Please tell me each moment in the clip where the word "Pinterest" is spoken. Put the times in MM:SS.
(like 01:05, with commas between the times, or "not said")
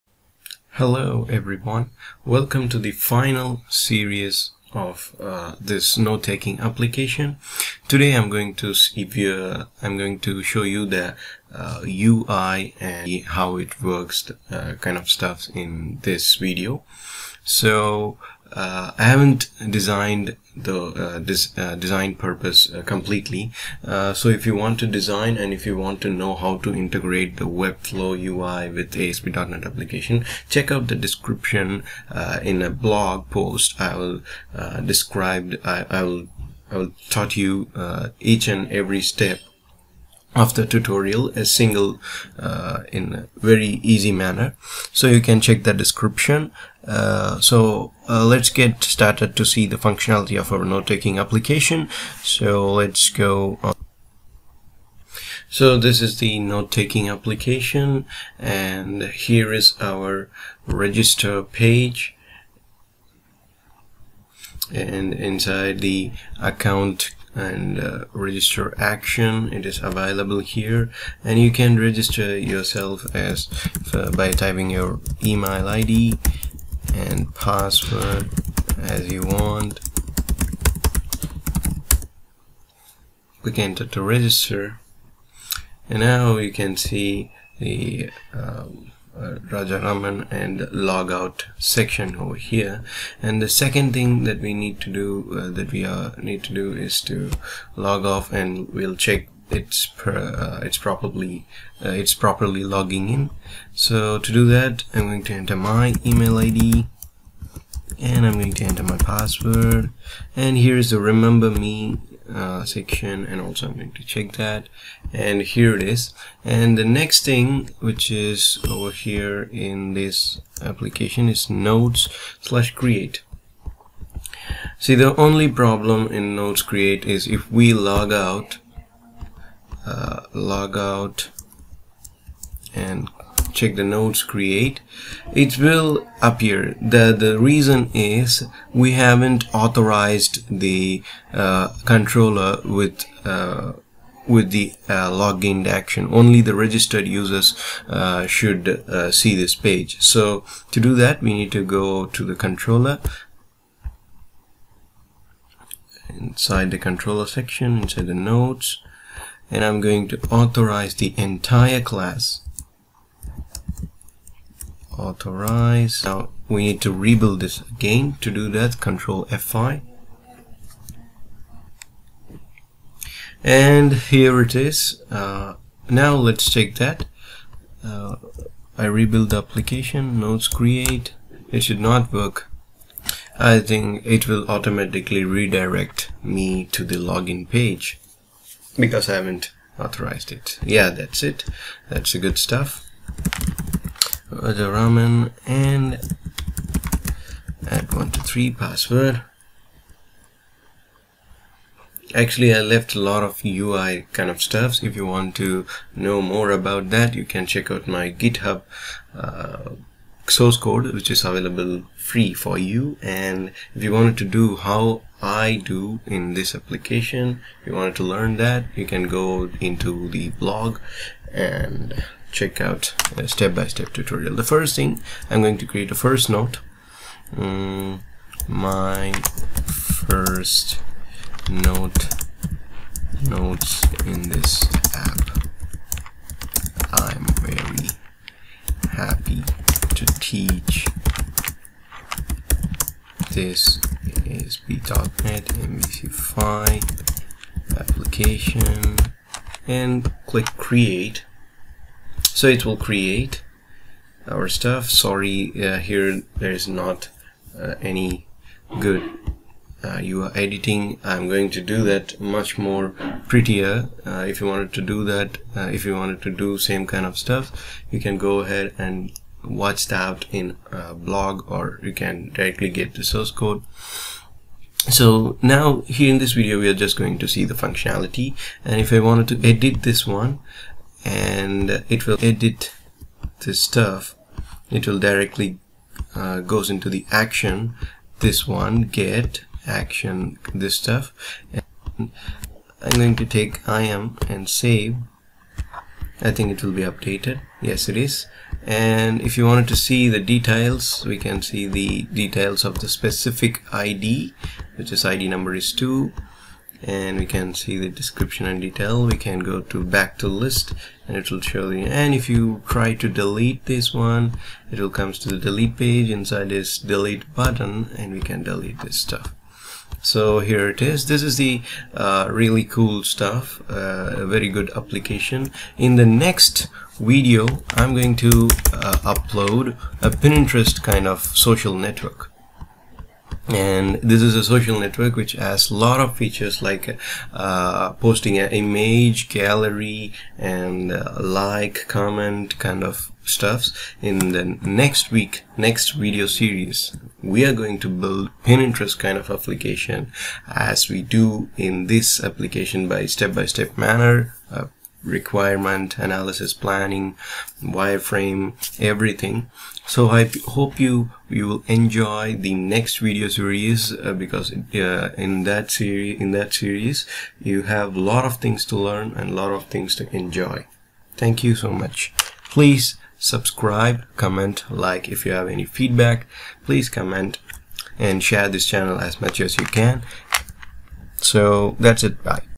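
05:30, 05:48.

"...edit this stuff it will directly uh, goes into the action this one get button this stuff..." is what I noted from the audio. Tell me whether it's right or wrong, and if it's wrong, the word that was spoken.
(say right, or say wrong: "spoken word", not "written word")
wrong: "action", not "button".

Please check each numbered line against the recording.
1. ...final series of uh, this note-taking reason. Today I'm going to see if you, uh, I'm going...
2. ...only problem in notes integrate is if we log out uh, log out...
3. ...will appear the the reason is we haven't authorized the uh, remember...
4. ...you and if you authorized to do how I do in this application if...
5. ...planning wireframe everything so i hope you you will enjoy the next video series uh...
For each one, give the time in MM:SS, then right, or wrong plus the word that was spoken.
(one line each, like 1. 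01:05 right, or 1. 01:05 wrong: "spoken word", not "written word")
1. 00:02 wrong: "application", not "reason"
2. 02:05 wrong: "create", not "integrate"
3. 02:15 wrong: "controller", not "remember"
4. 03:32 wrong: "wanted", not "authorized"
5. 05:56 right.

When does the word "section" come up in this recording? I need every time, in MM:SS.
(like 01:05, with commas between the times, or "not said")
01:31, 01:52, 02:37.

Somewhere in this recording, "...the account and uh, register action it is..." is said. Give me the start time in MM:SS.
01:05.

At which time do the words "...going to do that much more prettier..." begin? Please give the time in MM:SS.
04:21.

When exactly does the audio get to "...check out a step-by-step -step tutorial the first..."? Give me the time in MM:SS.
03:42.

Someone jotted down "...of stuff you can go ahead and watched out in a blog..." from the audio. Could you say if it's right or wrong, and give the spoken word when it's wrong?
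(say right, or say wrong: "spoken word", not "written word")
right.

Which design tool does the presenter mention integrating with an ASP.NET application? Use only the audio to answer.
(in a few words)
Webflow.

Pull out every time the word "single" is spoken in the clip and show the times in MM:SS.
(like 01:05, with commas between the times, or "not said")
00:41.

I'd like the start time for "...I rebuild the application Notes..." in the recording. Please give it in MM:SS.
02:58.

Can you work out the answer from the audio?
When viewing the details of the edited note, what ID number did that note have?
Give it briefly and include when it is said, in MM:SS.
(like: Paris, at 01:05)
2, at 05:05.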